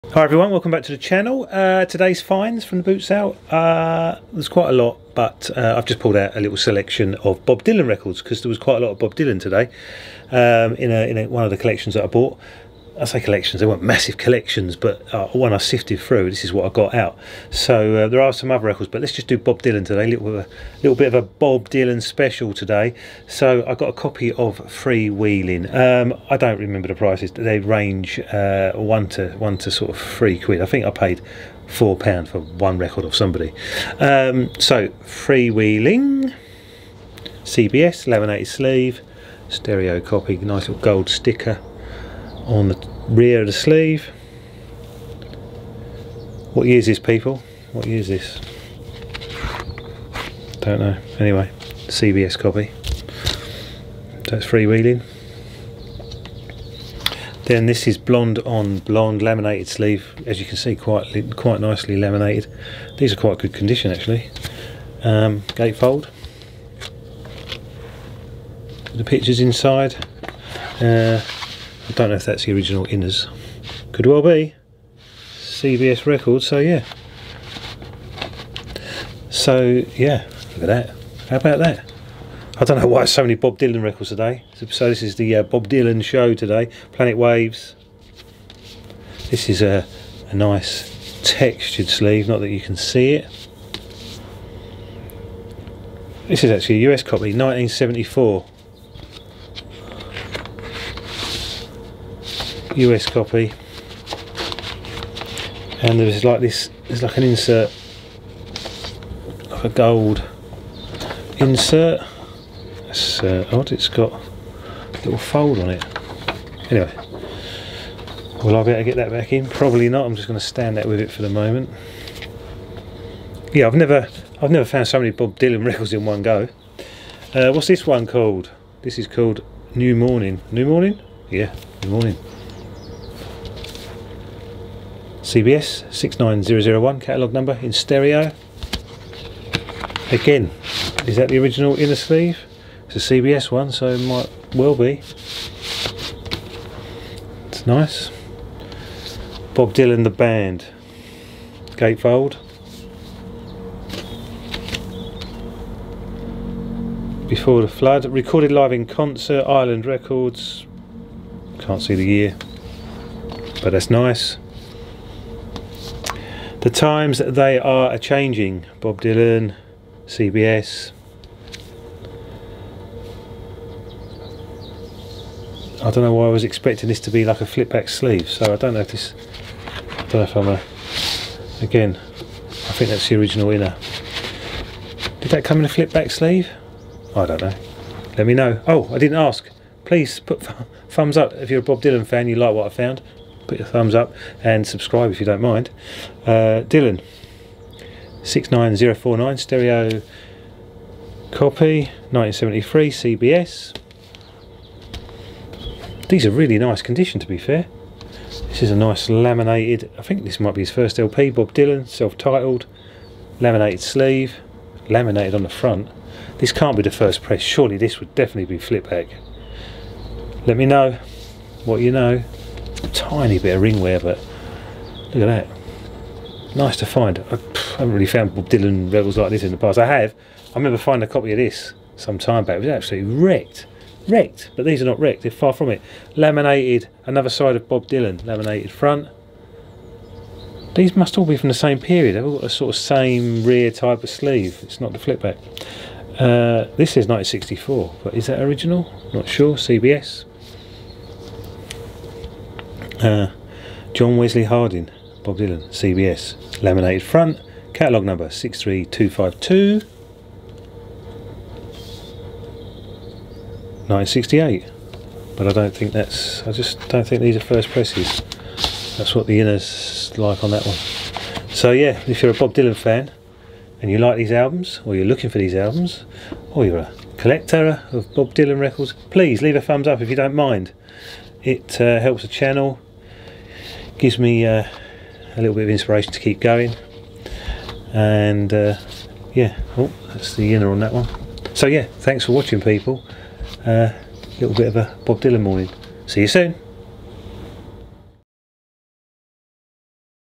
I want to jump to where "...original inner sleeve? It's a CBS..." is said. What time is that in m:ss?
2:21.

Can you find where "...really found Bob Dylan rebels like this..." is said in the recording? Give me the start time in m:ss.
3:47.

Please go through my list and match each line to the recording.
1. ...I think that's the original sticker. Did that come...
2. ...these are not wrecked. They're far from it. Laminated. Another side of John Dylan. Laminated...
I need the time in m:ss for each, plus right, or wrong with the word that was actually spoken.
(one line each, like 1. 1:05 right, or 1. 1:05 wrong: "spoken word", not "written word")
1. 3:02 wrong: "inner", not "sticker"
2. 3:54 wrong: "Bob", not "John".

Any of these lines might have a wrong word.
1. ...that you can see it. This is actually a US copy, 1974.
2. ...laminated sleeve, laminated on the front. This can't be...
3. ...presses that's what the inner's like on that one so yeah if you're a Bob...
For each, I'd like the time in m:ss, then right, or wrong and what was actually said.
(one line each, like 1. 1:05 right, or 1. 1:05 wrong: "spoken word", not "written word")
1. 1:32 right
2. 3:33 right
3. 4:27 right.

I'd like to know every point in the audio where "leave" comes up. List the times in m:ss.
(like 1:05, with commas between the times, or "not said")
4:39.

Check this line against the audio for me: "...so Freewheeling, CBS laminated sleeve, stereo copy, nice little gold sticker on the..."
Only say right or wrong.
right.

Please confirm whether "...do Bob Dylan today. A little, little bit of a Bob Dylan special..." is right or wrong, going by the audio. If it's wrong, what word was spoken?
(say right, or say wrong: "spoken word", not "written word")
right.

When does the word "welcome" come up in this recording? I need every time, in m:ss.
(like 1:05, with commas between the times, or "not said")
0:00.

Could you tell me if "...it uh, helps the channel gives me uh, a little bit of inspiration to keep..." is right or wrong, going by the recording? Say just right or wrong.
right.